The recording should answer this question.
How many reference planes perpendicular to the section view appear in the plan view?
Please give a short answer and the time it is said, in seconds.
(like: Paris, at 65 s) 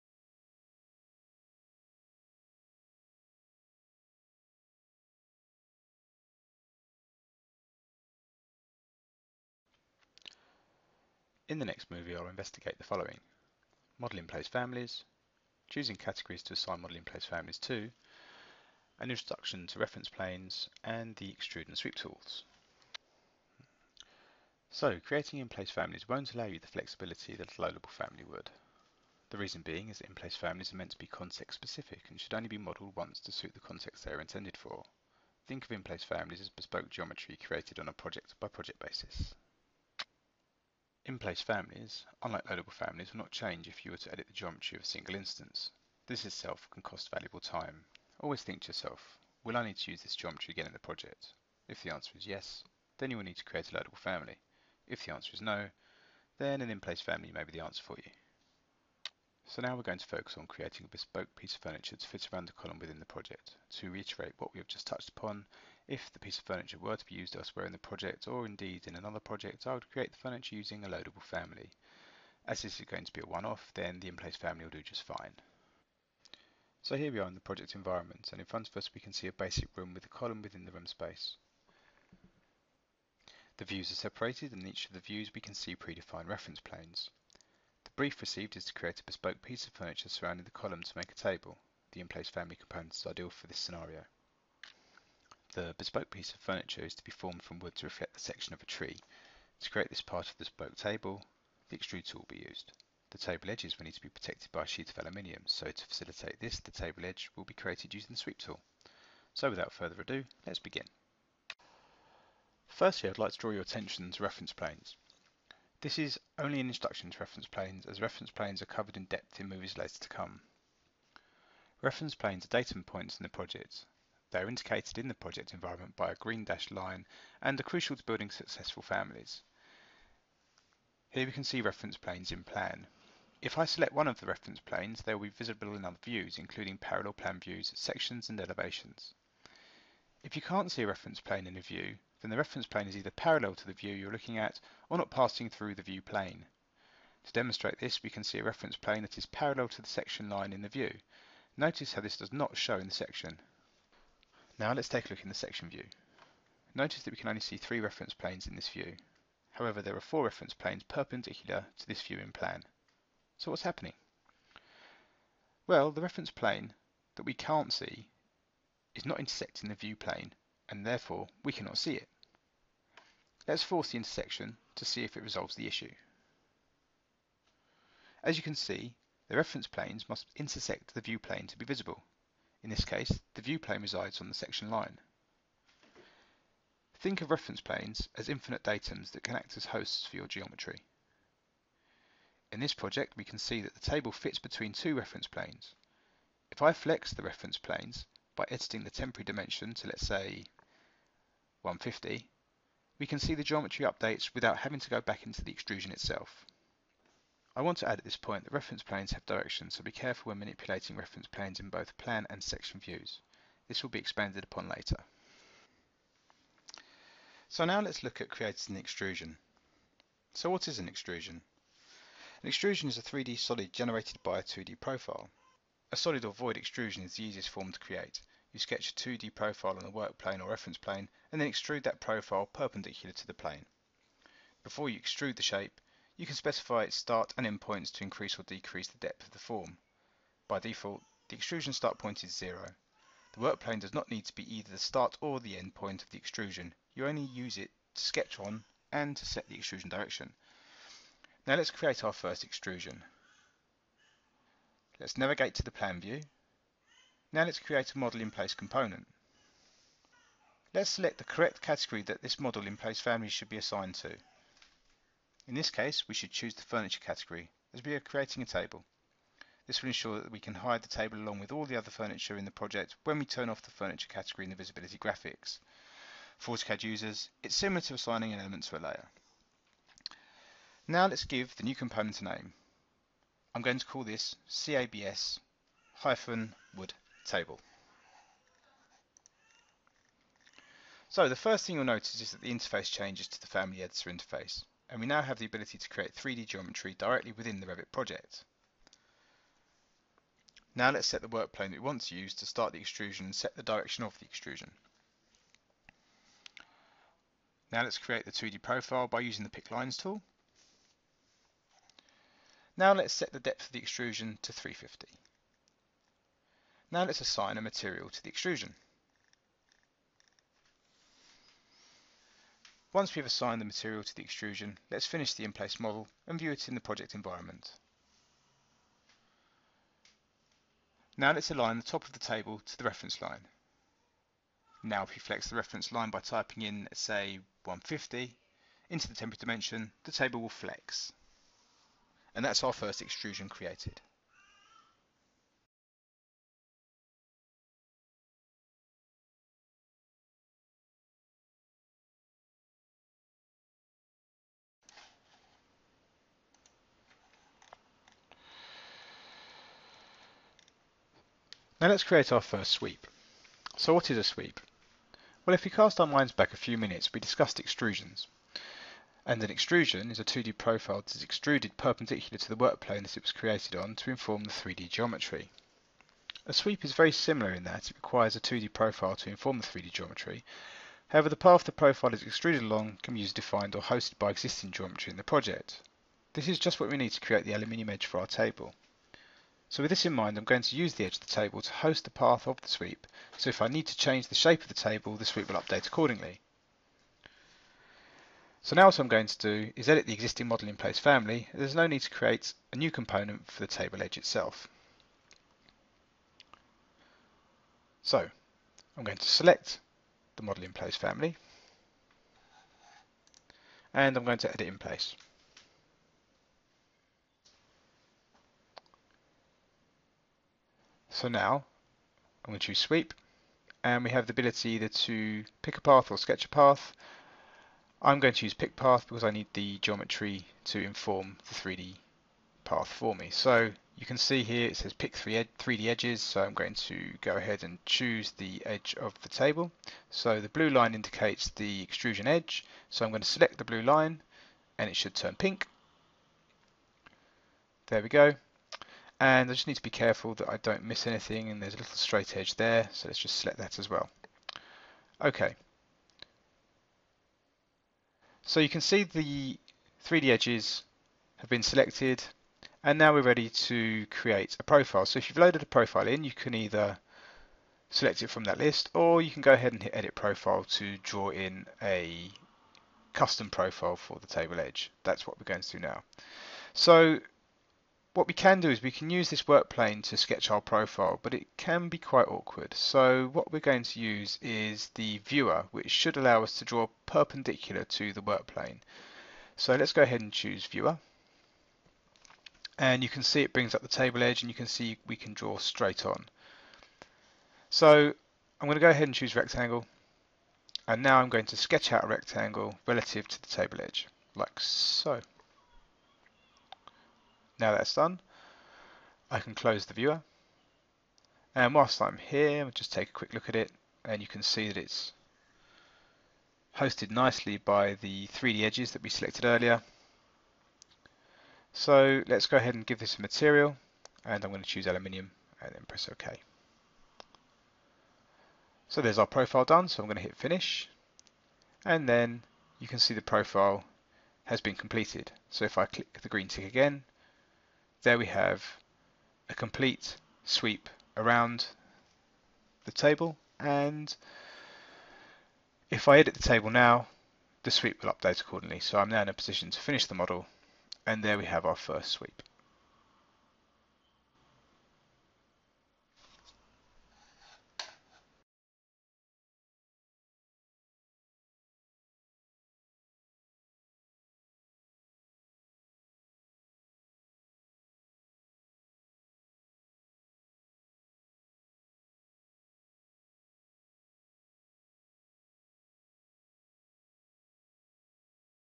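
4, at 160 s.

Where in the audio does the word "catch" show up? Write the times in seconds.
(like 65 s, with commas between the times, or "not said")
not said.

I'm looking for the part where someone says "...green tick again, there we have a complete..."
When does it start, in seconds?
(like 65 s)
536 s.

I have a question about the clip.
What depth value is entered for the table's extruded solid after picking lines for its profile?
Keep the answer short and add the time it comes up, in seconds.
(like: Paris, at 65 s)
350, at 314 s.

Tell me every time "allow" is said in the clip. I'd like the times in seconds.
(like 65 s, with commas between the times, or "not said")
26 s, 486 s.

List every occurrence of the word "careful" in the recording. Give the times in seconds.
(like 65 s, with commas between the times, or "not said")
209 s, 449 s.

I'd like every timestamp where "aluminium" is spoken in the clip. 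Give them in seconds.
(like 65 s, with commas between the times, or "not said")
104 s, 387 s, 524 s.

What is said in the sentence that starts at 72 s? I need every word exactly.
As this is going to be a one-off, then the in-place family will do just fine.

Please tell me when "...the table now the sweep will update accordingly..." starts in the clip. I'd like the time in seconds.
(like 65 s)
546 s.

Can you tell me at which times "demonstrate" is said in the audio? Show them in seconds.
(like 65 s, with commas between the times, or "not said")
147 s.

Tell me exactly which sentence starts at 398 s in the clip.
So now what I'm going to do is edit the existing model in place family.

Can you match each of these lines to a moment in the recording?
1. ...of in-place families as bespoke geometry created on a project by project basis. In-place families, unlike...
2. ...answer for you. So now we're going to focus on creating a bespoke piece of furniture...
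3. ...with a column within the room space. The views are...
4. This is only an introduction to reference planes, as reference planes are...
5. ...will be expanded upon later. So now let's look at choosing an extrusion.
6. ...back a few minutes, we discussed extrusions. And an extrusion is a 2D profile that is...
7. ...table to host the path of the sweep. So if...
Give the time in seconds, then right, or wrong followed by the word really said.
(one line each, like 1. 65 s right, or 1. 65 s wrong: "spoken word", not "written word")
1. 35 s right
2. 57 s right
3. 79 s right
4. 115 s right
5. 213 s wrong: "creating", not "choosing"
6. 366 s right
7. 391 s right.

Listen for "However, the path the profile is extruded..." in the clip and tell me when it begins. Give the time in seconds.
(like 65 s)
381 s.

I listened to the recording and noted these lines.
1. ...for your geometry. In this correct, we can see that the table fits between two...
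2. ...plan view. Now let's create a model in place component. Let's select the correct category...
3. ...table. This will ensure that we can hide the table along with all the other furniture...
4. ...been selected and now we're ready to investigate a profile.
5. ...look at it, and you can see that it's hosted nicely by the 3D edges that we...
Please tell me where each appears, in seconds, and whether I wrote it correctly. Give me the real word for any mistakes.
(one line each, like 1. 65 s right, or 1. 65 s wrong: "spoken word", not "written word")
1. 190 s wrong: "project", not "correct"
2. 255 s right
3. 268 s right
4. 461 s wrong: "create", not "investigate"
5. 513 s right.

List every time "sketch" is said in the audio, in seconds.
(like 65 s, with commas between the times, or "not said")
228 s, 248 s, 426 s, 480 s, 501 s.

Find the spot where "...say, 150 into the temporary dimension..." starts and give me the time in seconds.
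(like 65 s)
336 s.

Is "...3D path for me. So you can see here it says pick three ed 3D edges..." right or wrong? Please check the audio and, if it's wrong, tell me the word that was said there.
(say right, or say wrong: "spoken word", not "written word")
right.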